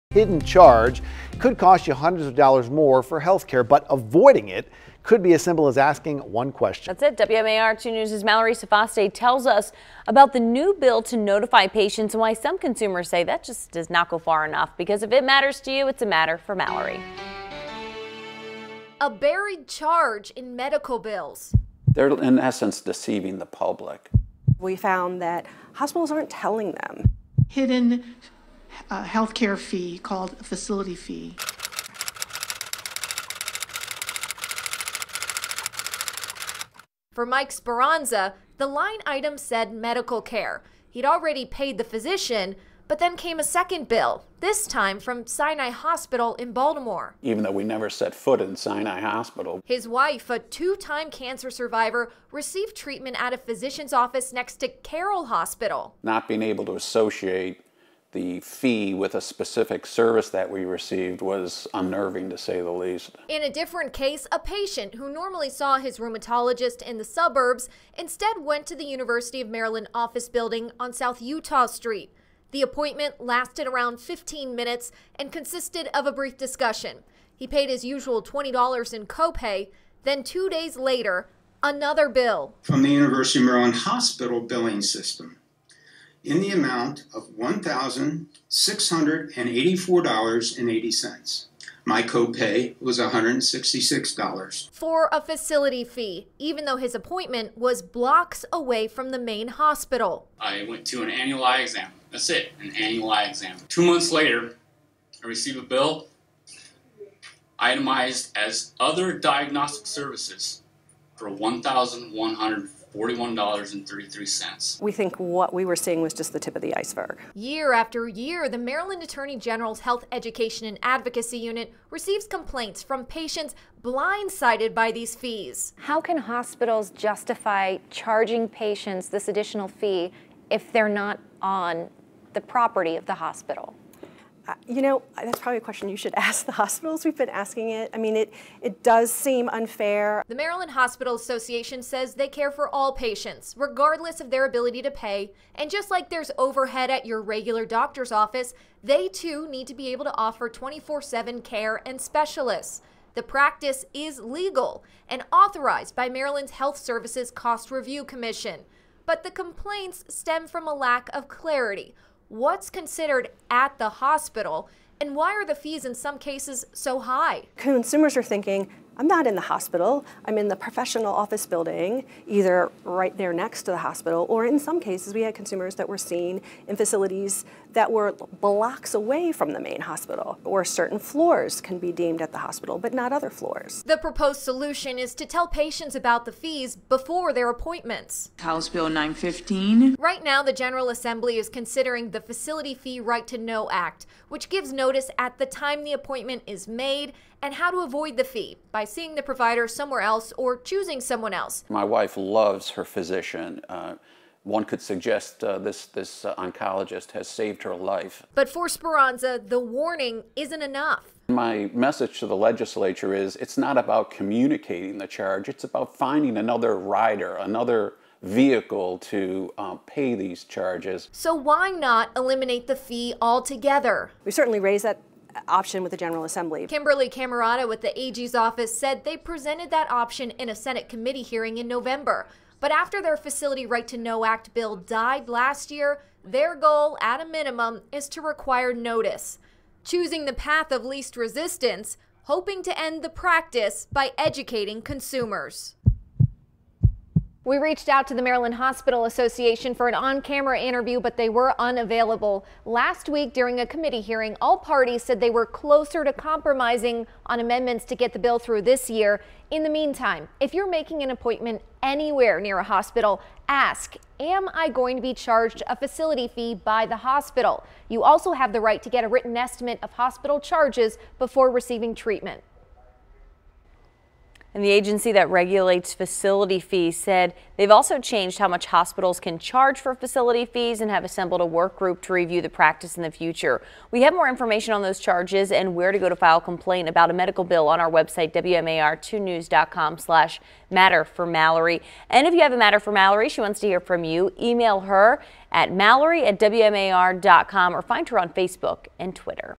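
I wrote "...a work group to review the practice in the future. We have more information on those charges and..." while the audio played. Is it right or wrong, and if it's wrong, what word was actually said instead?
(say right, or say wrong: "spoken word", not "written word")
right.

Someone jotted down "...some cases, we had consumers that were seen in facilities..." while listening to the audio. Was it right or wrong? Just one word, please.
right.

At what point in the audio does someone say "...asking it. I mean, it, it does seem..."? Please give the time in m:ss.
2:17.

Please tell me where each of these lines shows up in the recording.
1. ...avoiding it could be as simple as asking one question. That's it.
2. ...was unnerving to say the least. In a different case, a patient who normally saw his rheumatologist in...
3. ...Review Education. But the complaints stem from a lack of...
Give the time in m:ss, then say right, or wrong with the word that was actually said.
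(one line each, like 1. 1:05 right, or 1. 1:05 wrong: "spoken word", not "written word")
1. 0:03 right
2. 1:01 right
3. 2:37 wrong: "Commission", not "Education".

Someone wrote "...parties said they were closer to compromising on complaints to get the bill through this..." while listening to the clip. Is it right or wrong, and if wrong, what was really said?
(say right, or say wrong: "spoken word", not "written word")
wrong: "amendments", not "complaints".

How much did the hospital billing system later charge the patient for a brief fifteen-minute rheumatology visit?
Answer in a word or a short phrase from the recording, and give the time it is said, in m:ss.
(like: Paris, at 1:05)
$1,684.80, at 1:27.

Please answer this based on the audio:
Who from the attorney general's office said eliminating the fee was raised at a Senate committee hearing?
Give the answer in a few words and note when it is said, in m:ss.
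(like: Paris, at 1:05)
Kimberly Cammarata, at 3:46.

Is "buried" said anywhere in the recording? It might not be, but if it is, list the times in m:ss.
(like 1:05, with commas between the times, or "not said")
0:19.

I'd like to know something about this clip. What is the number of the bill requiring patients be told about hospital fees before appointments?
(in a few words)
915.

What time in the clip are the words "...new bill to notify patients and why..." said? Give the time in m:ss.
0:10.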